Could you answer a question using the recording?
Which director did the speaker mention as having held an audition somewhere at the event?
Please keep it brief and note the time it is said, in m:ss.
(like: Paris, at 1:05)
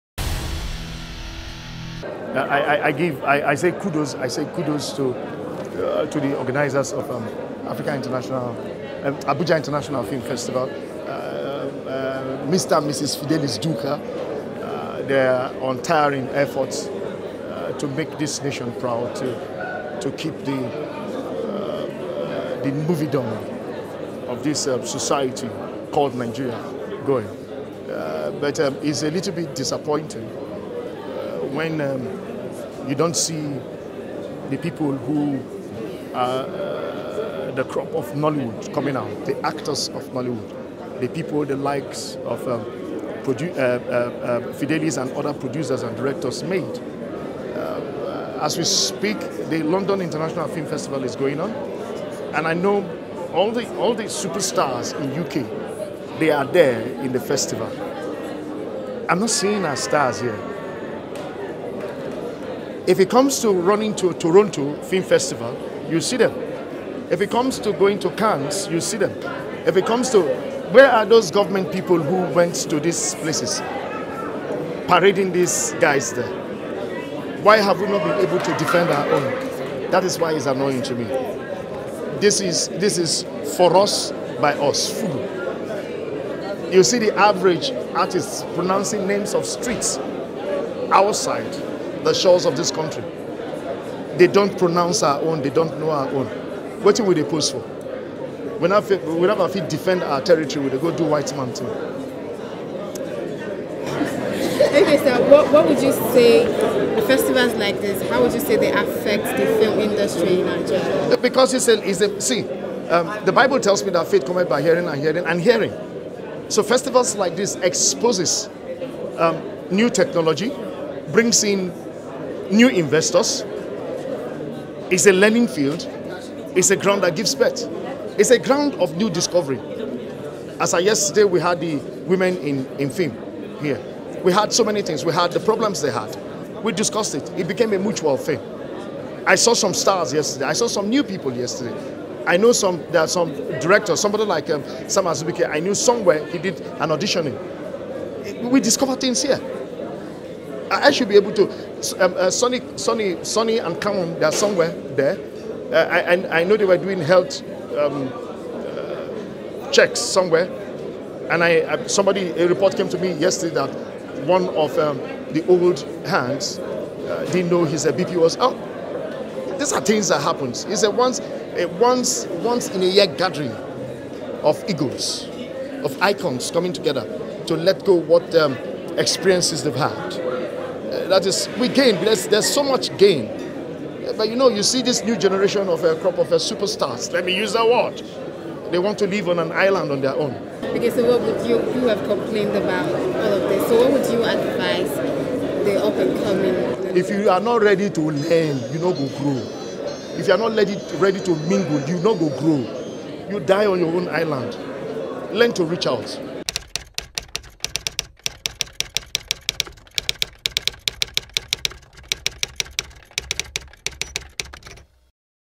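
Sam Azubuike, at 2:24.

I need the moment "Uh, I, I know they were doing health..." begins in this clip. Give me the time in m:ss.
2:35.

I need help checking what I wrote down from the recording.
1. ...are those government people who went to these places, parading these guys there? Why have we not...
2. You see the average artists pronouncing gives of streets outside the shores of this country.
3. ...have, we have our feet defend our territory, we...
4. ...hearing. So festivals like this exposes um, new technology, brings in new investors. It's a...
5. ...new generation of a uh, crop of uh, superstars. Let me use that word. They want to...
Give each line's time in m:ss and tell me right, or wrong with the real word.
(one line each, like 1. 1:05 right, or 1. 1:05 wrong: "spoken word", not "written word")
1. 1:10 right
2. 1:26 wrong: "names", not "gives"
3. 1:38 right
4. 1:55 right
5. 3:05 right.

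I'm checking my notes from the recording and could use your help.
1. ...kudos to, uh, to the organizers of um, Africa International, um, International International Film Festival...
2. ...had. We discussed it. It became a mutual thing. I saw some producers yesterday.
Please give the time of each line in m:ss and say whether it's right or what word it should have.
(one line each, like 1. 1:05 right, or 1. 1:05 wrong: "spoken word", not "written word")
1. 0:04 wrong: "Abuja", not "International"
2. 2:15 wrong: "stars", not "producers".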